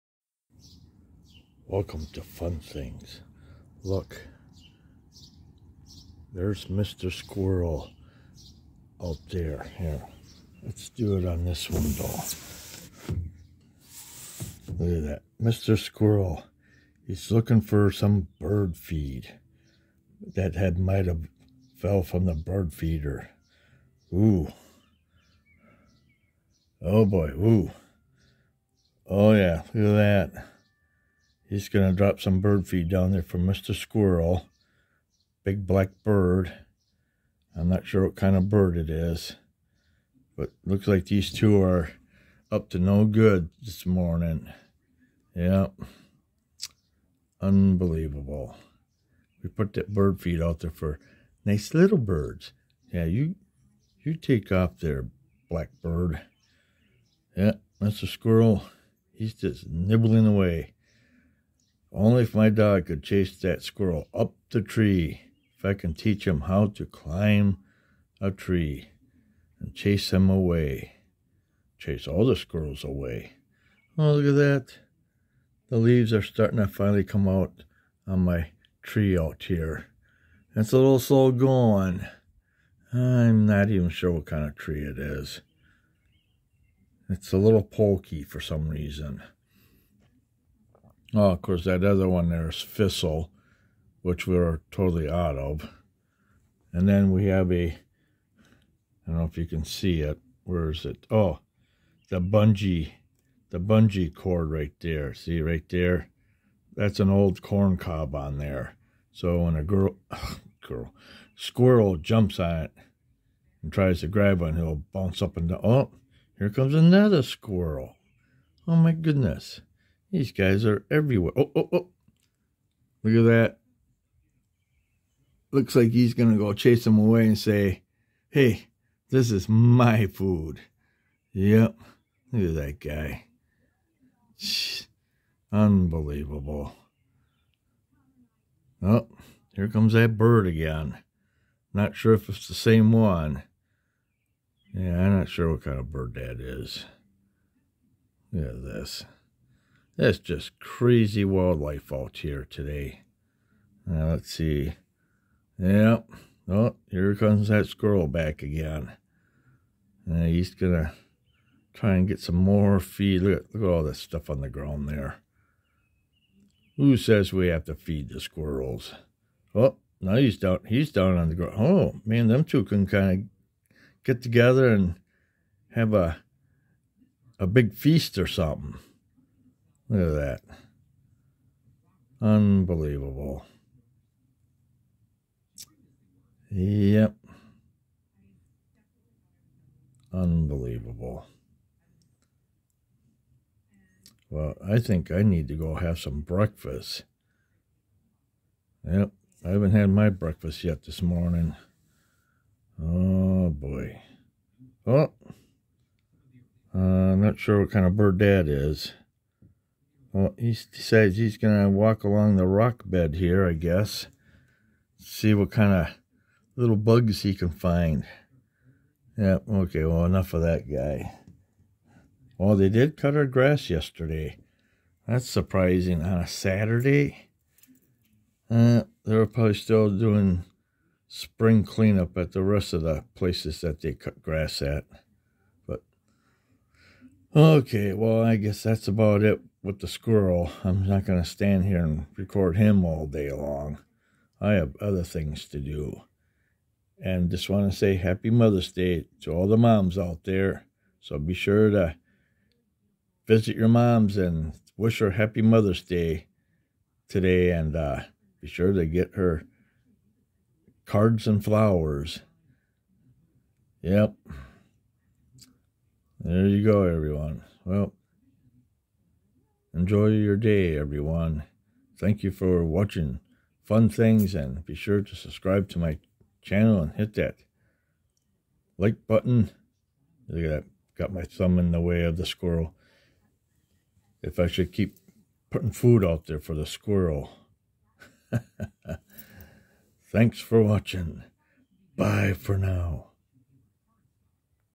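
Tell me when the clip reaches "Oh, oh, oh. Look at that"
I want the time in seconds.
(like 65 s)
121 s.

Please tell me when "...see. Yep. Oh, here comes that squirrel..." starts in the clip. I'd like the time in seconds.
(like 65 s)
154 s.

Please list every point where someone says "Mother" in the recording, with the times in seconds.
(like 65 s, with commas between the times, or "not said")
248 s, 255 s.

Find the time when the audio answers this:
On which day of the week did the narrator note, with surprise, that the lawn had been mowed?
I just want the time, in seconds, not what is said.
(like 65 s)
226 s.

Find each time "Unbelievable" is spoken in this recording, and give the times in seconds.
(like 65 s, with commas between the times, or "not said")
47 s, 135 s, 182 s, 190 s.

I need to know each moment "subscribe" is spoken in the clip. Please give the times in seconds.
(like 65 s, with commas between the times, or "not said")
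275 s.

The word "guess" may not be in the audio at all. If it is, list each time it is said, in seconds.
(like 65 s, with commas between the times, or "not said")
213 s, 238 s.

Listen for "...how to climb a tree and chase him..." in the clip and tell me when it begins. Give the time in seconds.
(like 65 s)
66 s.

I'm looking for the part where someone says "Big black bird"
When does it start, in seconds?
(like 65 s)
35 s.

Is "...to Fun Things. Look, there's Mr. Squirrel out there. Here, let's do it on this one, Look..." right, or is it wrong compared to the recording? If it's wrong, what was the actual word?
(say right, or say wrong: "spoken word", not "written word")
right.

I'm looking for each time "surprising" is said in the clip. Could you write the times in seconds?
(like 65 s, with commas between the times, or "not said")
225 s.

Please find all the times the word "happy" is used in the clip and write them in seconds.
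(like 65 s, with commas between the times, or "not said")
247 s, 255 s.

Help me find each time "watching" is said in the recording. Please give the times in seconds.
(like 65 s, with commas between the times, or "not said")
272 s, 290 s.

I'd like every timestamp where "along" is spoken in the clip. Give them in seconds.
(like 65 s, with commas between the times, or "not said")
212 s.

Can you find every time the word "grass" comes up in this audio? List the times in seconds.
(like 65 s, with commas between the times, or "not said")
223 s, 234 s.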